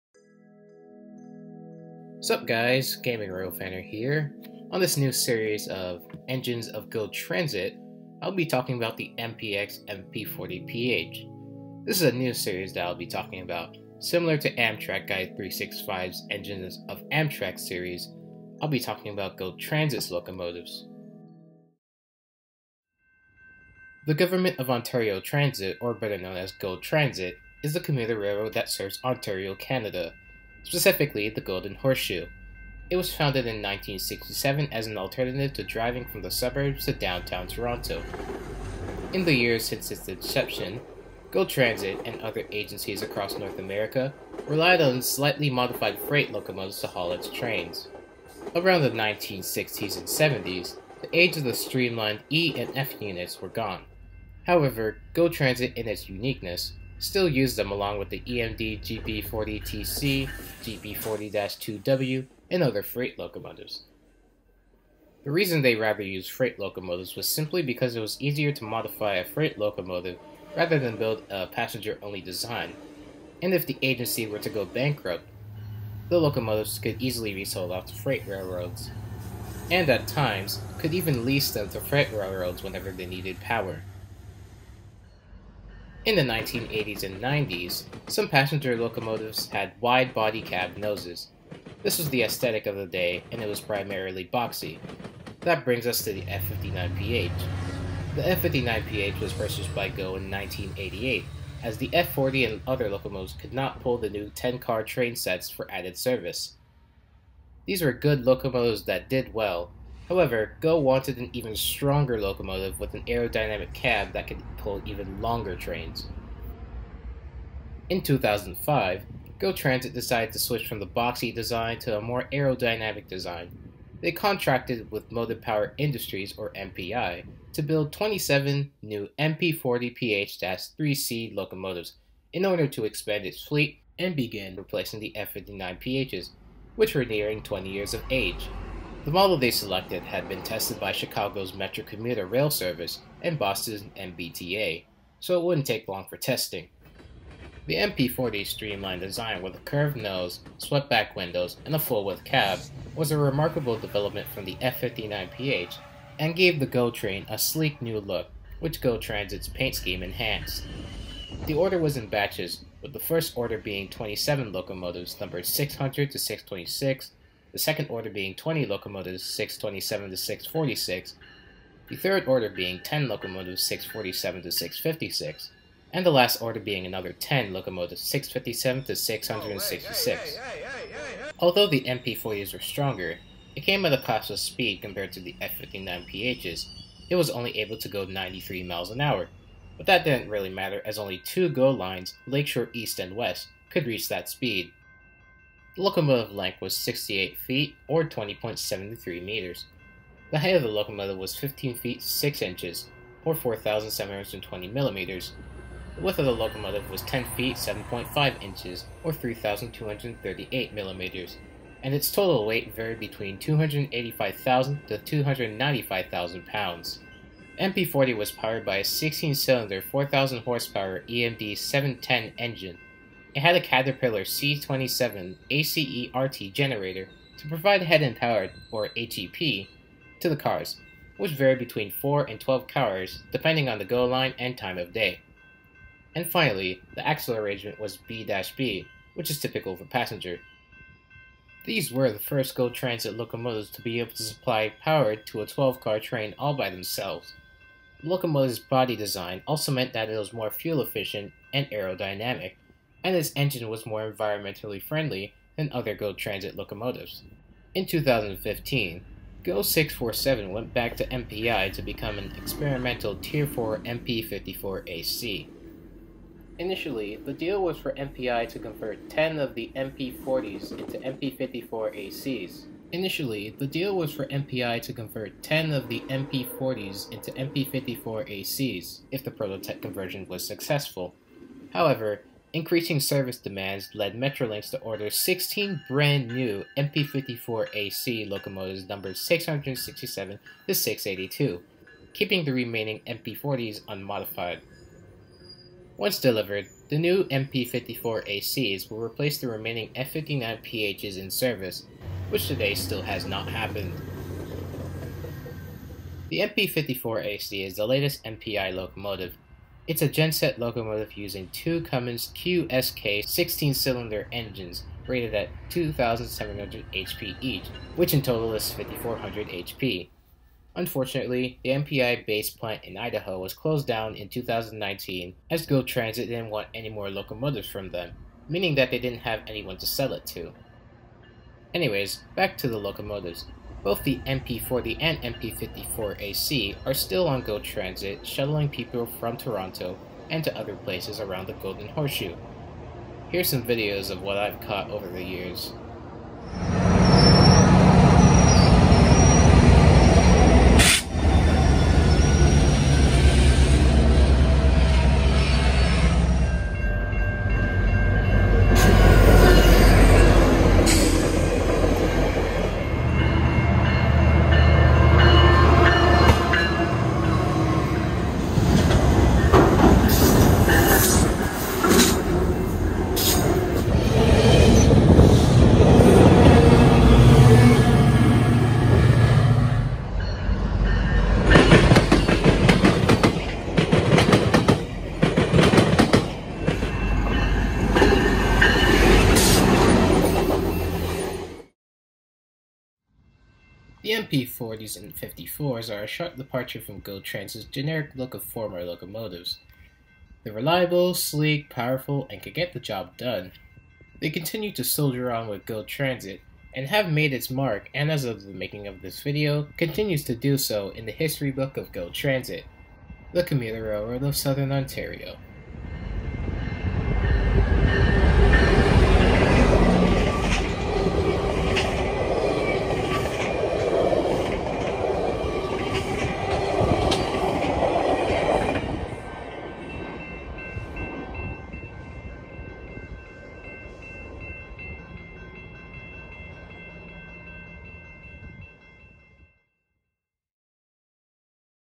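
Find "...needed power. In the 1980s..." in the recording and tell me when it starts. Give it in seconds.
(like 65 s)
83 s.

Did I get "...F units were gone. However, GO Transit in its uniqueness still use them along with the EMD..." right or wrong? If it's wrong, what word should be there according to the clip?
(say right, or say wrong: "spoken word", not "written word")
right.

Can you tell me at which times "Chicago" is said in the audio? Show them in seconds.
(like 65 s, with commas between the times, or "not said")
140 s.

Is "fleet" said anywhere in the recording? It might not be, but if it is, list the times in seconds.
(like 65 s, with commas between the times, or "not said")
133 s.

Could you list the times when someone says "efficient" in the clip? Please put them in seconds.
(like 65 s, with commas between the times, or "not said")
250 s.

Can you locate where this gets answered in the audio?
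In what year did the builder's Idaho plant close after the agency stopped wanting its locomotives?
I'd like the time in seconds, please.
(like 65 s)
324 s.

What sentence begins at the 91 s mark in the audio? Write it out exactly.
This was the aesthetic of the day, and it was primarily boxy.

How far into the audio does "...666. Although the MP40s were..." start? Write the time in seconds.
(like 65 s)
178 s.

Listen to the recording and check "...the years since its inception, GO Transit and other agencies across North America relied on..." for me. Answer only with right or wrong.
right.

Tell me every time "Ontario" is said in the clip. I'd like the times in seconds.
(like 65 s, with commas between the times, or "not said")
24 s, 29 s, 414 s.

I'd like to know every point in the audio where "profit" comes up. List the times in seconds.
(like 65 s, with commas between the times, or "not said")
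not said.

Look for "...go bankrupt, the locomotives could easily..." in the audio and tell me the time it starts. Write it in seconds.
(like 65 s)
74 s.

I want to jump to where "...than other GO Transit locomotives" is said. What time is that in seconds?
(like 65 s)
255 s.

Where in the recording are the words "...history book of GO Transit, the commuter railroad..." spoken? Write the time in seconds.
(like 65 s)
411 s.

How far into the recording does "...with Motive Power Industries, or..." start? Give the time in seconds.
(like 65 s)
124 s.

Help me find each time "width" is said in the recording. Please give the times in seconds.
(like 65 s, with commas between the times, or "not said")
151 s, 206 s.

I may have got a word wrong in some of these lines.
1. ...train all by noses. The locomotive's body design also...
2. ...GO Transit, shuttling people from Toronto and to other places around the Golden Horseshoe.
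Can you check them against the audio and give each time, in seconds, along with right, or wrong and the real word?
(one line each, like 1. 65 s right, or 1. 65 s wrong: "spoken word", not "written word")
1. 246 s wrong: "themselves", not "noses"
2. 337 s right.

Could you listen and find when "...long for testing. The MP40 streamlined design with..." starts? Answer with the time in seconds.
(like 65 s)
145 s.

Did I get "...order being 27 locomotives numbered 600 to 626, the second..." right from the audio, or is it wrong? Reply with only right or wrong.
right.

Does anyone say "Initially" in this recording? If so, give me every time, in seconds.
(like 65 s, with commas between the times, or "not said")
266 s, 272 s.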